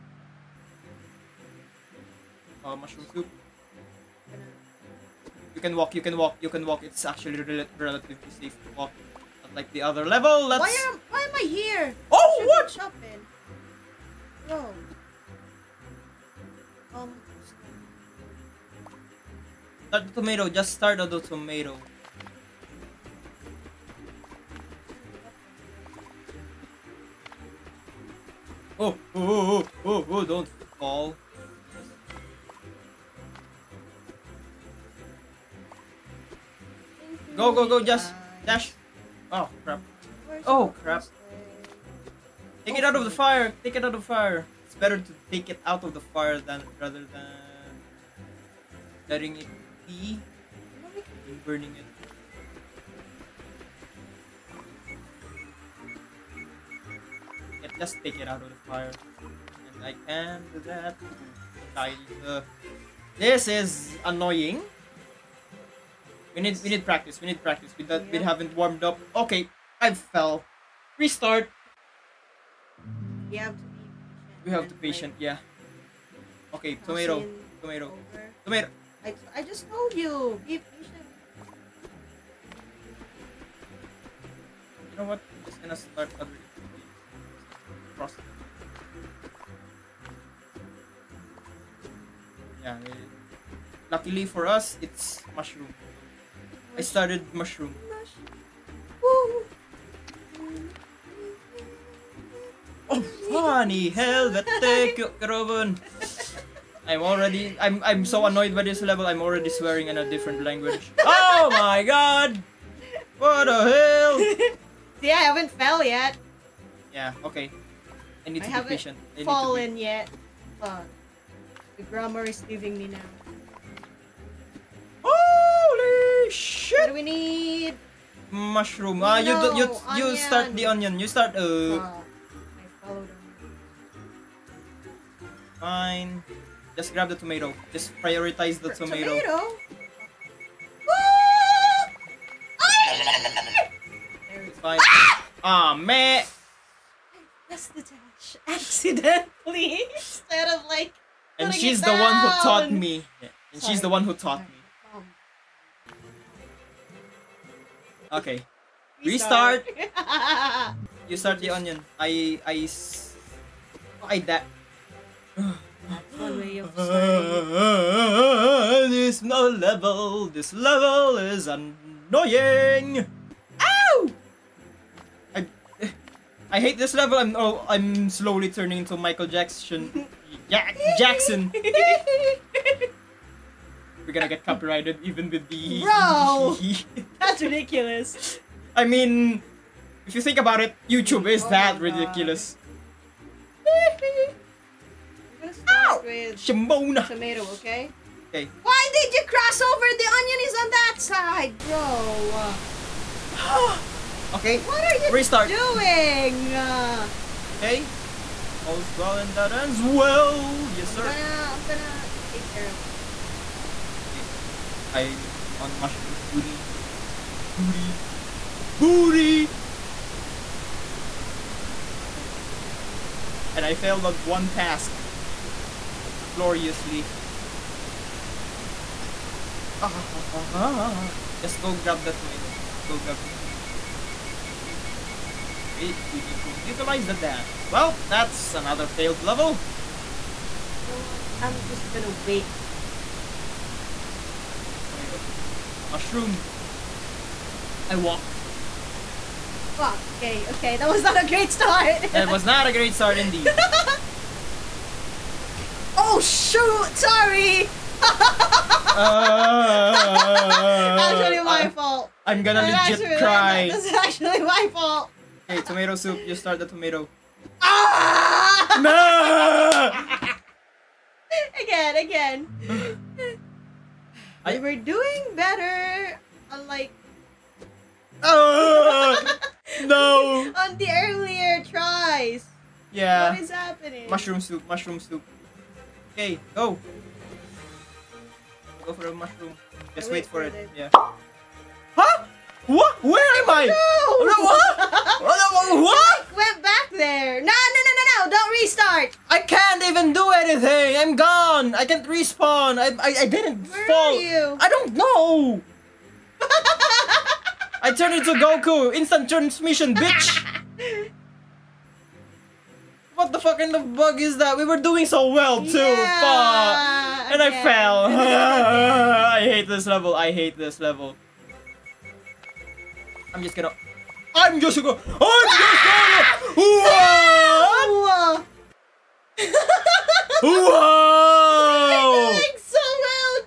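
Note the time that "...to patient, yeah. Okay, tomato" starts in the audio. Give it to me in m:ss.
1:14.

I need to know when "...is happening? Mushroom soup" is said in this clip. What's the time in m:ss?
4:43.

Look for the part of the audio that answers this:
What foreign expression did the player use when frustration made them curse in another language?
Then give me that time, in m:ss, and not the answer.
1:43.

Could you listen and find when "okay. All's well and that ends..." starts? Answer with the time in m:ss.
3:27.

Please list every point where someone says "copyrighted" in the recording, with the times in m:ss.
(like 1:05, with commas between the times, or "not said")
3:04.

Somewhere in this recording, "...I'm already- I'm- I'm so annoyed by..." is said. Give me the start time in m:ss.
1:46.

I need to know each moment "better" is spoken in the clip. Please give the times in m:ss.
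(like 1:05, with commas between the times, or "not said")
0:44, 4:35.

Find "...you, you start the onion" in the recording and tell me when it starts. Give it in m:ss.
2:09.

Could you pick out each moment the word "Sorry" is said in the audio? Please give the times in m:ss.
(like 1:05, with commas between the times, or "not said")
2:33, 4:16.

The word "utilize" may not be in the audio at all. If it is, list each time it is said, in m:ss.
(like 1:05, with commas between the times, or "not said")
3:56.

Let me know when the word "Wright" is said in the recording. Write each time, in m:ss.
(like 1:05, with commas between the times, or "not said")
not said.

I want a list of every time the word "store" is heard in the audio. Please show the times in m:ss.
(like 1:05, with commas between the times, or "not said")
not said.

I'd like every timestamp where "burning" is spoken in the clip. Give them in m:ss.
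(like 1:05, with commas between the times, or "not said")
0:51.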